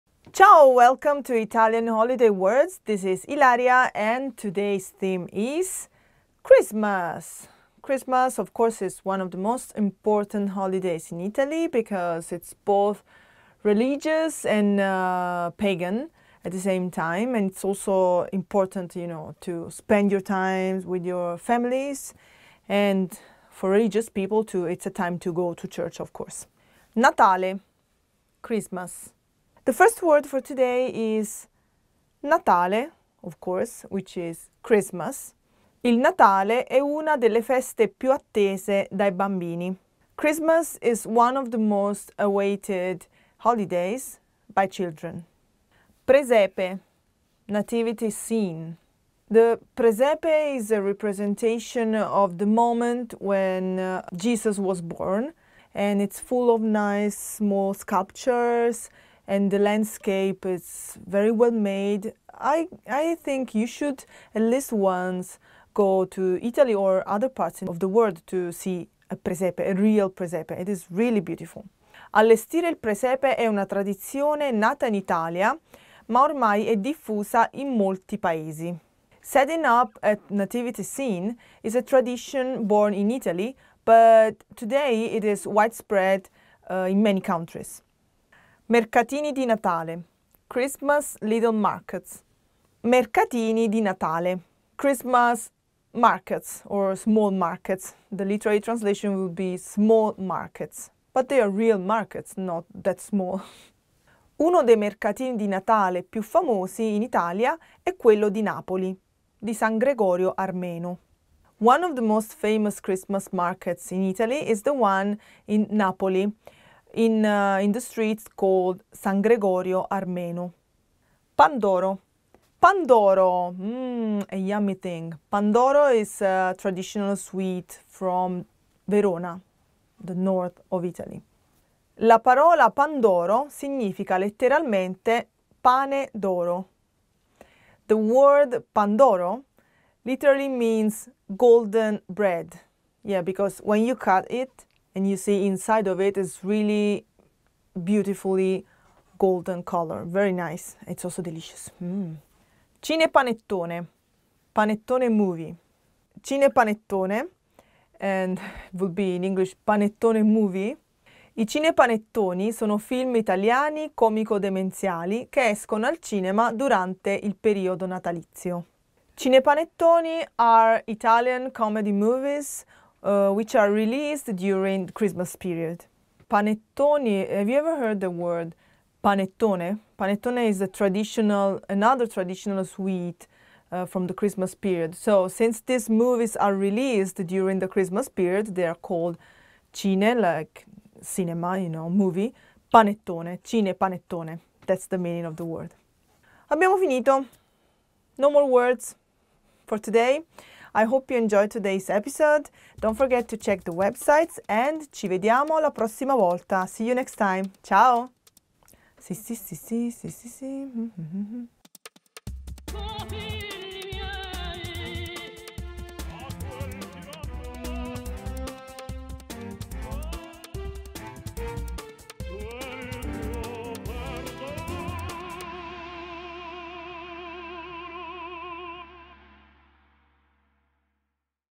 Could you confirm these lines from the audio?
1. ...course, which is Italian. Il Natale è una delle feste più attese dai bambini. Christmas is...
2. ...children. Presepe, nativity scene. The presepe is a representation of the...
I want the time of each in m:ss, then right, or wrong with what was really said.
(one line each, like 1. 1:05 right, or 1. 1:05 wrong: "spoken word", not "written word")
1. 0:33 wrong: "Christmas", not "Italian"
2. 0:44 right.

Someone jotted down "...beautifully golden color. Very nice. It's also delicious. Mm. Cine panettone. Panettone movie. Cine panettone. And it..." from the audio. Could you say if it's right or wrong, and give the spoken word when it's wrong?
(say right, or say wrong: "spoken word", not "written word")
right.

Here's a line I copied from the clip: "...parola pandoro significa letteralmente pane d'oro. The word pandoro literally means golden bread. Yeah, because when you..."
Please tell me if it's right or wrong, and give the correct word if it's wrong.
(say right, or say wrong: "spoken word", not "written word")
right.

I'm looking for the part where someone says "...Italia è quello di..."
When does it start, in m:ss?
1:47.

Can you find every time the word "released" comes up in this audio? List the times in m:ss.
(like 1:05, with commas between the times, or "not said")
2:53, 3:06.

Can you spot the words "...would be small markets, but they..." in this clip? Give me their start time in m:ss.
1:39.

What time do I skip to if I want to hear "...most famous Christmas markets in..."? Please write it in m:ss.
1:52.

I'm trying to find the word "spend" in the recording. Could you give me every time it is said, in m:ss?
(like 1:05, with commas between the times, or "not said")
0:19.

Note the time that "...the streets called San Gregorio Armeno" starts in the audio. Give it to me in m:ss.
1:57.